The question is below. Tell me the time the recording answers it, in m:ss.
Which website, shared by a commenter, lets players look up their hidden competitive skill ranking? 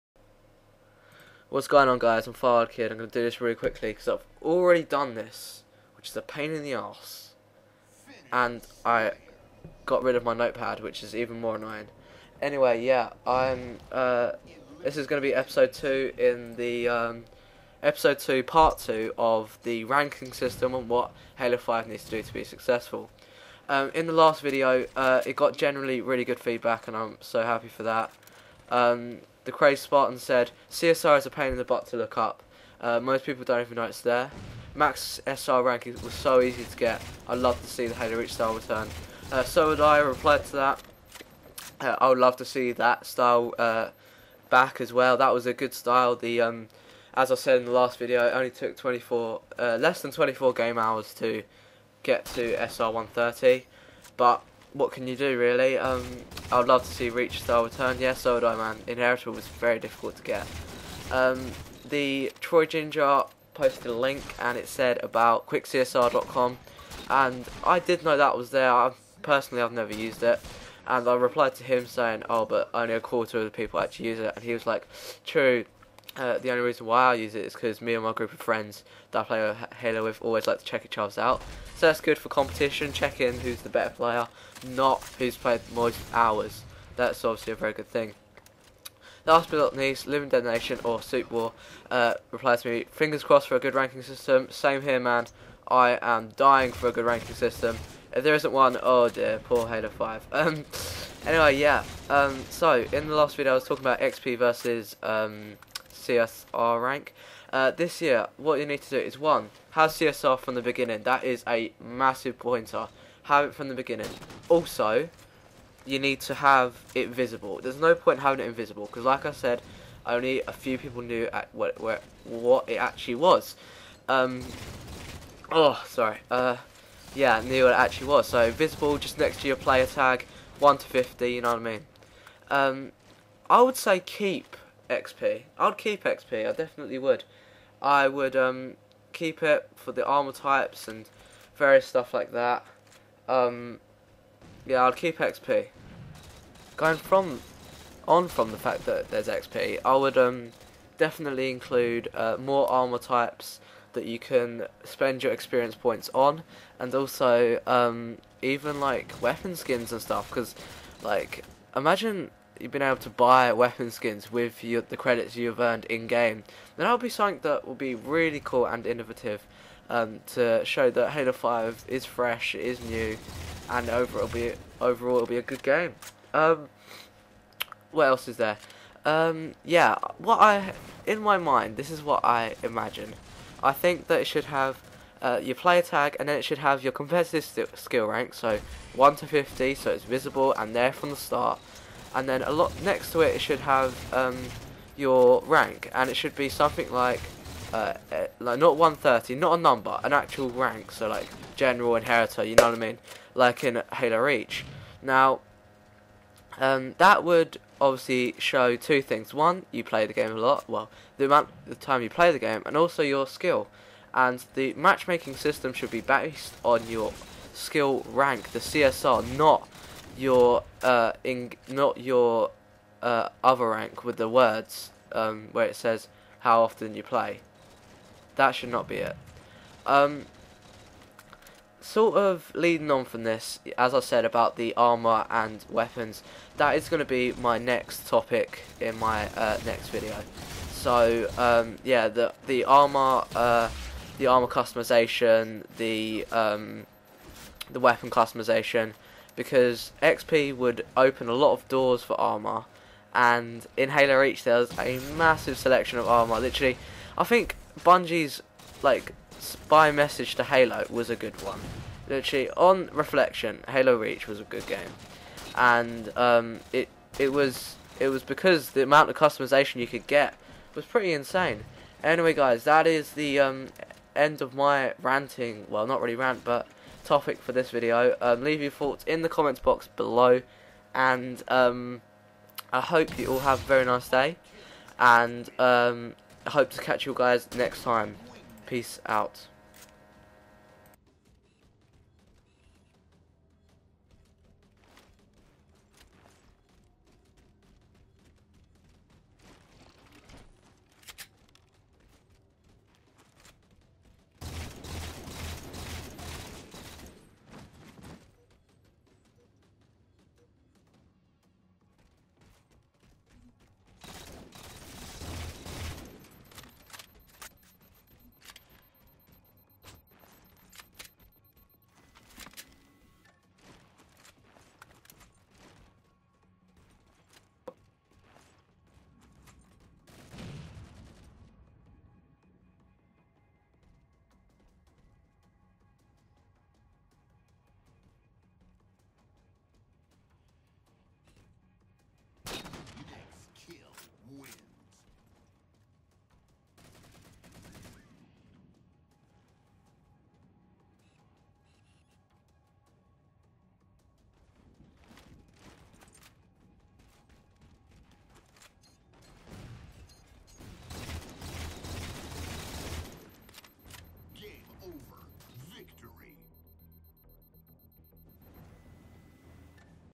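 1:05.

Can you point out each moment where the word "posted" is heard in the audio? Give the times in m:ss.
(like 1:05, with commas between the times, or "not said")
1:03.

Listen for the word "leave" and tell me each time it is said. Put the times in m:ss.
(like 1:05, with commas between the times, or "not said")
4:38.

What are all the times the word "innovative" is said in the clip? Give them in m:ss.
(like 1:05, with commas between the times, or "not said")
2:48.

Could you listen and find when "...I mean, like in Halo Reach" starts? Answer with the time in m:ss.
3:22.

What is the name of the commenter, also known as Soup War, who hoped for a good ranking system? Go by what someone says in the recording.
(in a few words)
Living Dead Nation.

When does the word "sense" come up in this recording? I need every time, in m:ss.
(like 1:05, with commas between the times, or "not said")
not said.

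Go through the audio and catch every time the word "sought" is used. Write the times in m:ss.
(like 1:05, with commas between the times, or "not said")
not said.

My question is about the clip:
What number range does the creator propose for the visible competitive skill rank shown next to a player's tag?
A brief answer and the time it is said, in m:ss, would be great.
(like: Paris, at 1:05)
1 to 50, at 3:08.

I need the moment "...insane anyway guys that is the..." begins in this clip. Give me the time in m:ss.
4:31.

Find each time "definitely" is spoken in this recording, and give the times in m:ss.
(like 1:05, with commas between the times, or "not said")
2:16, 2:30.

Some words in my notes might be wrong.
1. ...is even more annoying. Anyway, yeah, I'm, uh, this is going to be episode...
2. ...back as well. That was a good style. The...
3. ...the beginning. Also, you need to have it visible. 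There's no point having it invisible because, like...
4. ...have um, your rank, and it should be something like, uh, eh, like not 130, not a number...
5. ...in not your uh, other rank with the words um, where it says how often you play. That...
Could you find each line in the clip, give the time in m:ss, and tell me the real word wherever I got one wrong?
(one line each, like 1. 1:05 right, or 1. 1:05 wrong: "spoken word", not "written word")
1. 0:11 right
2. 0:44 right
3. 1:53 right
4. 3:13 right
5. 3:41 right.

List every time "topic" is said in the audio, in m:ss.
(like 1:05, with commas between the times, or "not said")
3:58, 4:37.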